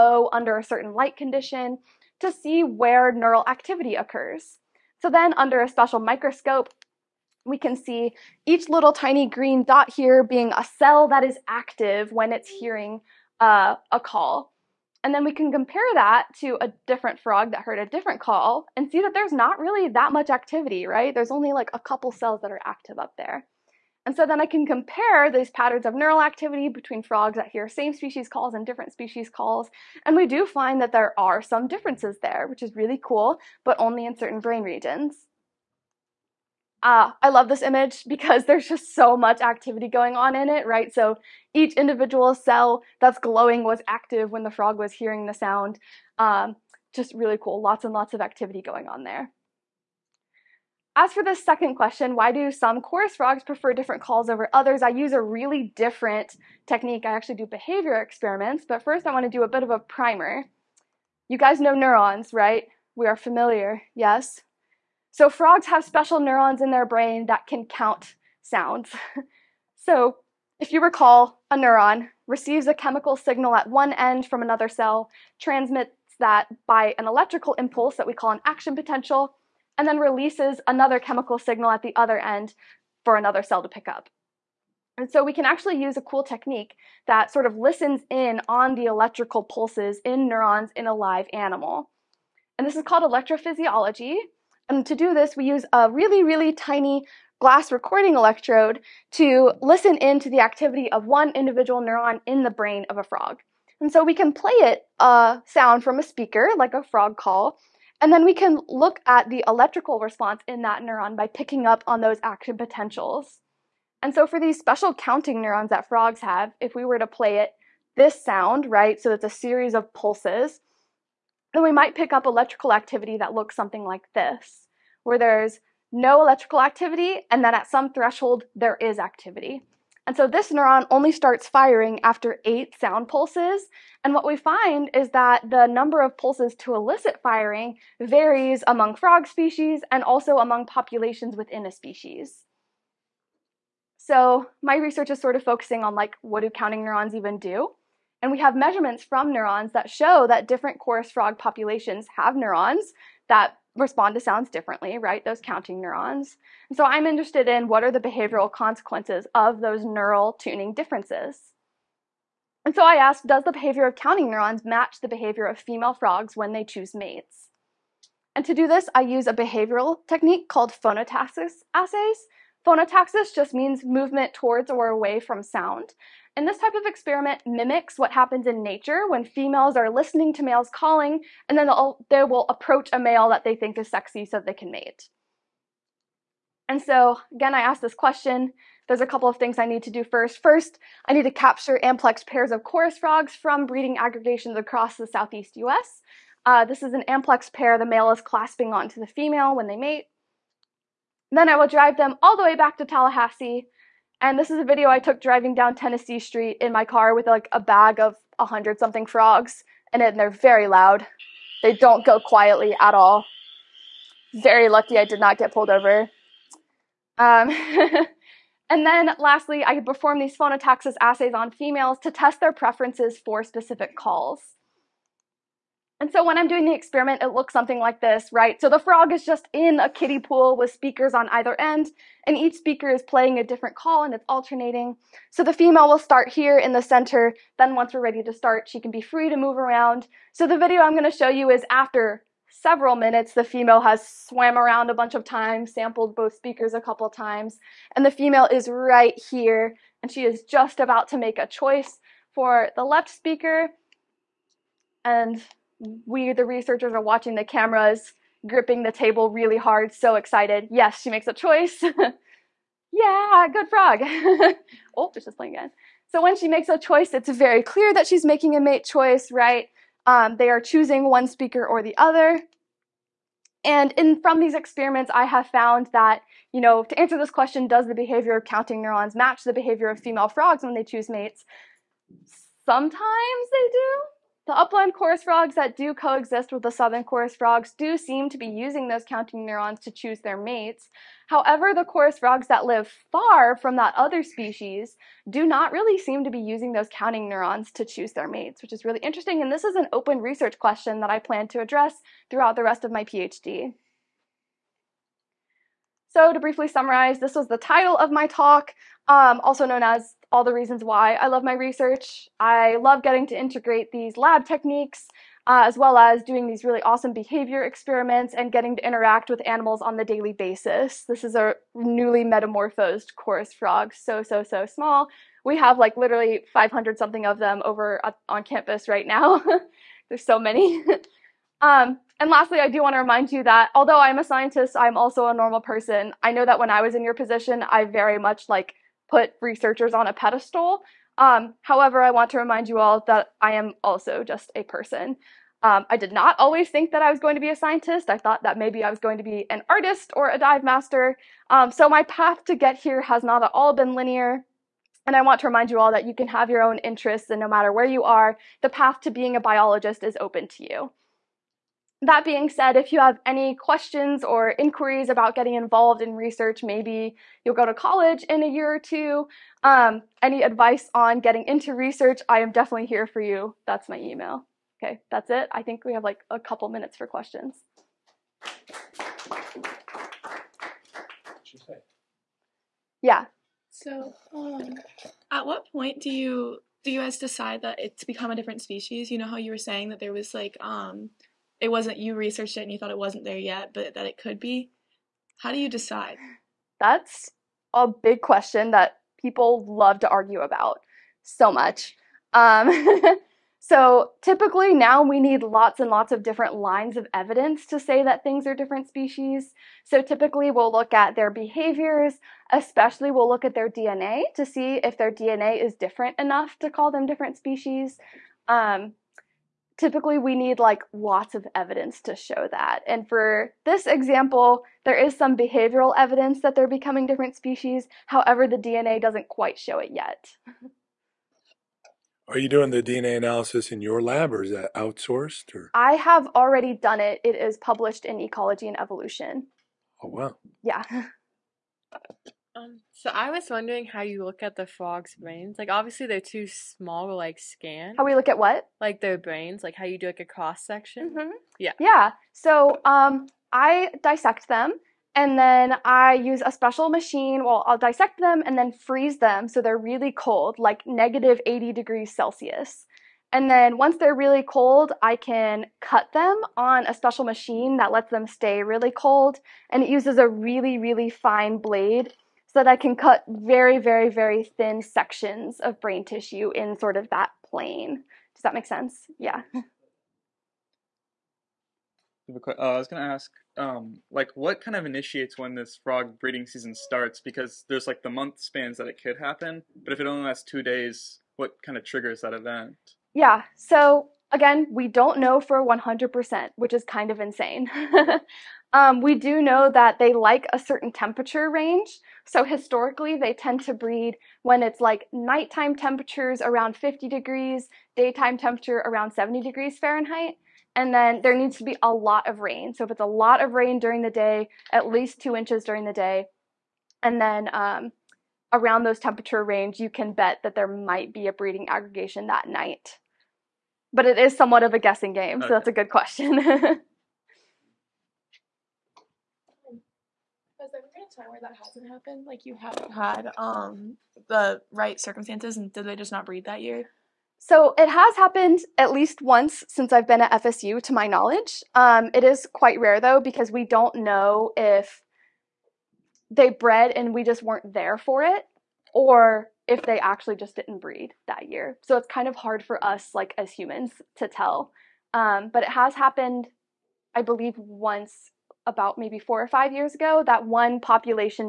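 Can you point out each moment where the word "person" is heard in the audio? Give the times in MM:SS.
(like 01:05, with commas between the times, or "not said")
05:35, 05:44.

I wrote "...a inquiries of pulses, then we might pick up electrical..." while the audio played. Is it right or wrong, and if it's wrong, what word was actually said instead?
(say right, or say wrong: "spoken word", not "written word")
wrong: "series", not "inquiries".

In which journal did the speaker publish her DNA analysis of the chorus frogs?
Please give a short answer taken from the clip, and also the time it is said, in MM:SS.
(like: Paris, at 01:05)
Ecology and Evolution, at 07:18.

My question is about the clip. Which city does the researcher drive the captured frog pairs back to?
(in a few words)
Tallahassee.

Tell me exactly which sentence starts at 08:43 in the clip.
But it is somewhat of a guessing game, okay.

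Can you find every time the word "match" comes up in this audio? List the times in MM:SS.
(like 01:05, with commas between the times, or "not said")
02:44, 04:39.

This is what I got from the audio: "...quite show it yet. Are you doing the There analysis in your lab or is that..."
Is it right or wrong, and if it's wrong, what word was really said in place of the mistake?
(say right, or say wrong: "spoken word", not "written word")
wrong: "DNA", not "There".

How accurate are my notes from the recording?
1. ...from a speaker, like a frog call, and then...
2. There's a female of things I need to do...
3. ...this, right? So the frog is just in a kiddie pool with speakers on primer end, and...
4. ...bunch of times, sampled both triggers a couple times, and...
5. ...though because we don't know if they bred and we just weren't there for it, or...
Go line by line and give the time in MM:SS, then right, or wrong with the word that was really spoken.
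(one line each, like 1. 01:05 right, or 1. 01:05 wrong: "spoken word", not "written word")
1. 01:45 right
2. 03:08 wrong: "couple", not "female"
3. 03:47 wrong: "either", not "primer"
4. 04:04 wrong: "speakers", not "triggers"
5. 09:02 right.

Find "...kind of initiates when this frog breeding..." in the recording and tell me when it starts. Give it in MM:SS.
08:04.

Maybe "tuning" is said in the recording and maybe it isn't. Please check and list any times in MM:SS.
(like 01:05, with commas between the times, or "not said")
02:40.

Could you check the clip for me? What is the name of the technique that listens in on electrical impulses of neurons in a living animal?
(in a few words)
Electrophysiology.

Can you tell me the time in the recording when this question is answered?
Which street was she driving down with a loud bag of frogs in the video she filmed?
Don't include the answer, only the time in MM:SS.
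03:25.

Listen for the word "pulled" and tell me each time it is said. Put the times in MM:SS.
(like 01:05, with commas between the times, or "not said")
03:35.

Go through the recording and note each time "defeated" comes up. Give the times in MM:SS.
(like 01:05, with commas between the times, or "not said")
not said.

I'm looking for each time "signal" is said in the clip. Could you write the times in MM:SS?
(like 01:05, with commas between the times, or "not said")
01:13, 01:21.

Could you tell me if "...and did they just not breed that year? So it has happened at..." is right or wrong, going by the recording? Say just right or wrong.
right.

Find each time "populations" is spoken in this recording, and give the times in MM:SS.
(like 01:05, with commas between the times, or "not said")
02:20, 02:31, 09:20.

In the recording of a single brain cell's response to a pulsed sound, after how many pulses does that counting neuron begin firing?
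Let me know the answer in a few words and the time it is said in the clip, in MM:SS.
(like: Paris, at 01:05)
8, at 02:12.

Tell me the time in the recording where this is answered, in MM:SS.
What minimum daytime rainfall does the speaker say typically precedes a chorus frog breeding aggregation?
08:35.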